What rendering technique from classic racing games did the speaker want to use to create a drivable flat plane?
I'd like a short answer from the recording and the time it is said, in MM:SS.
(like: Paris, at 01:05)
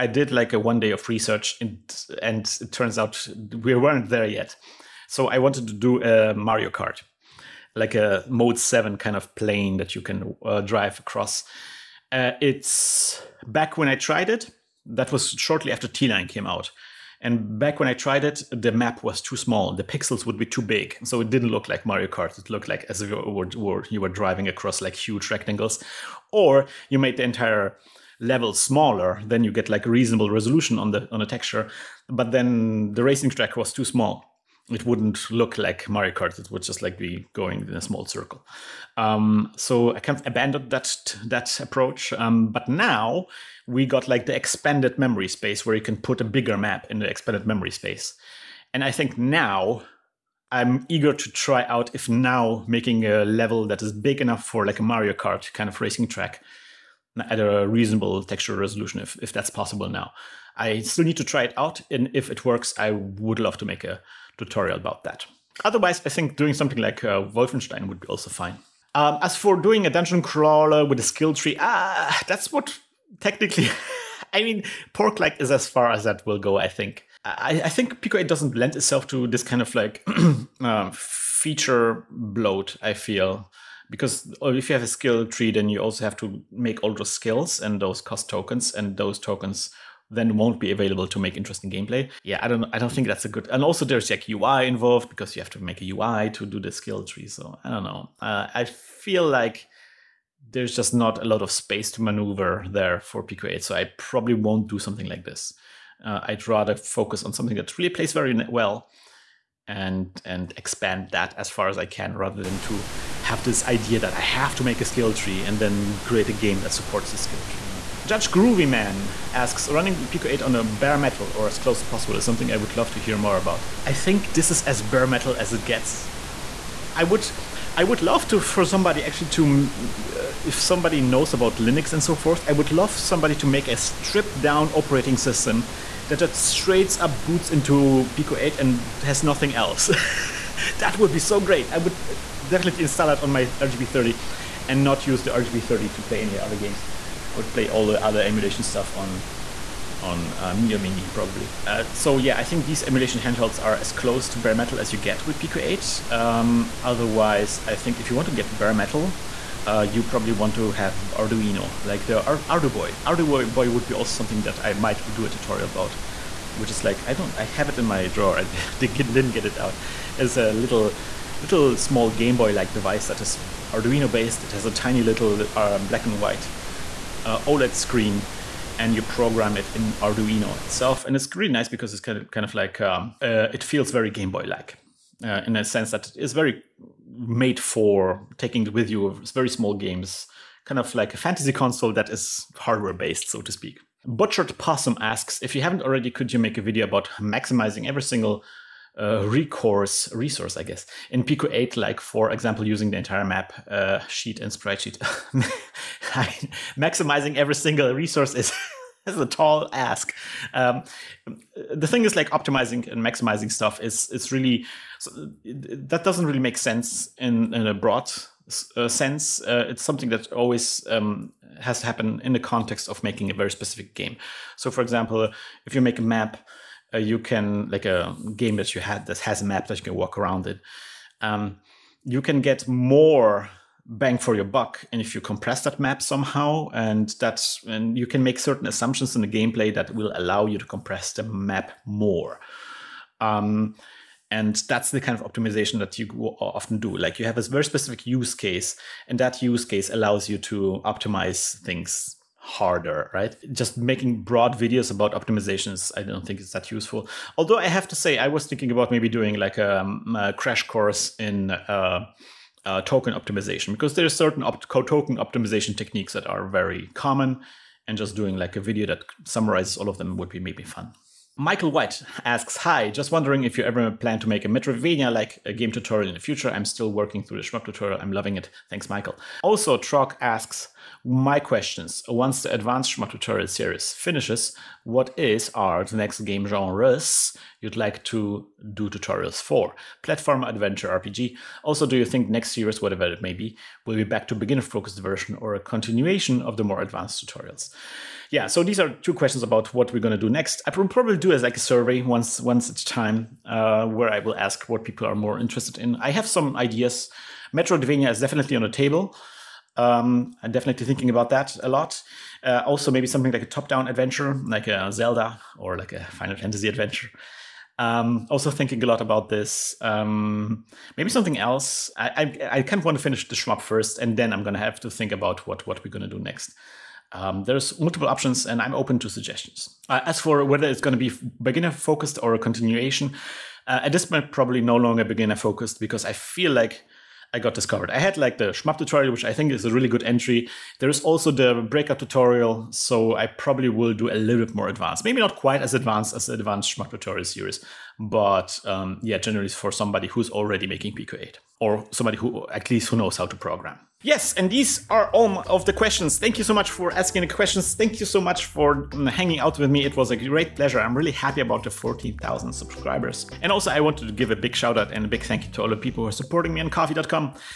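Mode Seven, at 00:08.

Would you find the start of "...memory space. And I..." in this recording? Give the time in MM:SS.
00:47.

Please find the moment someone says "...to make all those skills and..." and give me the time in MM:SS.
01:26.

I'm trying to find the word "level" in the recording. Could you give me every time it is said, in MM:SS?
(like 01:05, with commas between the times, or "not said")
00:28, 00:53.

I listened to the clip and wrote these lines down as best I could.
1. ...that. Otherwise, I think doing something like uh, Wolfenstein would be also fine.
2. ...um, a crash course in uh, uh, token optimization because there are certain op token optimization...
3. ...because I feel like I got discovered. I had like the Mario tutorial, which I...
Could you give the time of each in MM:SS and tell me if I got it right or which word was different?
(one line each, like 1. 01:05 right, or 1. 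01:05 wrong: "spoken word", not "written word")
1. 01:05 right
2. 04:19 right
3. 05:35 wrong: "Schmup", not "Mario".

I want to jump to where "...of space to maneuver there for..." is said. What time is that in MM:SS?
01:41.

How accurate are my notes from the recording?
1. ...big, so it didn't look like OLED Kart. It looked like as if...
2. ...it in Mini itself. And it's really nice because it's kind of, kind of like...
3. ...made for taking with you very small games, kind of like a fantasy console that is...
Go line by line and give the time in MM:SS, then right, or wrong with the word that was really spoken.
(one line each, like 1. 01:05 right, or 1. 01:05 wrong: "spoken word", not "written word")
1. 00:20 wrong: "Mario", not "OLED"
2. 02:59 wrong: "Arduino", not "Mini"
3. 03:07 right.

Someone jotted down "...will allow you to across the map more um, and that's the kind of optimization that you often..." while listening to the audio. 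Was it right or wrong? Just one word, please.
wrong.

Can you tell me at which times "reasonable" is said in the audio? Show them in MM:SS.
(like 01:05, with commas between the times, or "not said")
00:29, 00:57.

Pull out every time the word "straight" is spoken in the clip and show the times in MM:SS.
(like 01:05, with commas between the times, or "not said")
02:16.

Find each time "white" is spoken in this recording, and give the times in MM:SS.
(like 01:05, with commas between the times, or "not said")
02:56, 04:31.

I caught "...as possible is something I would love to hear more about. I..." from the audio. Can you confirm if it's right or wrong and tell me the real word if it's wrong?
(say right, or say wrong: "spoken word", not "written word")
right.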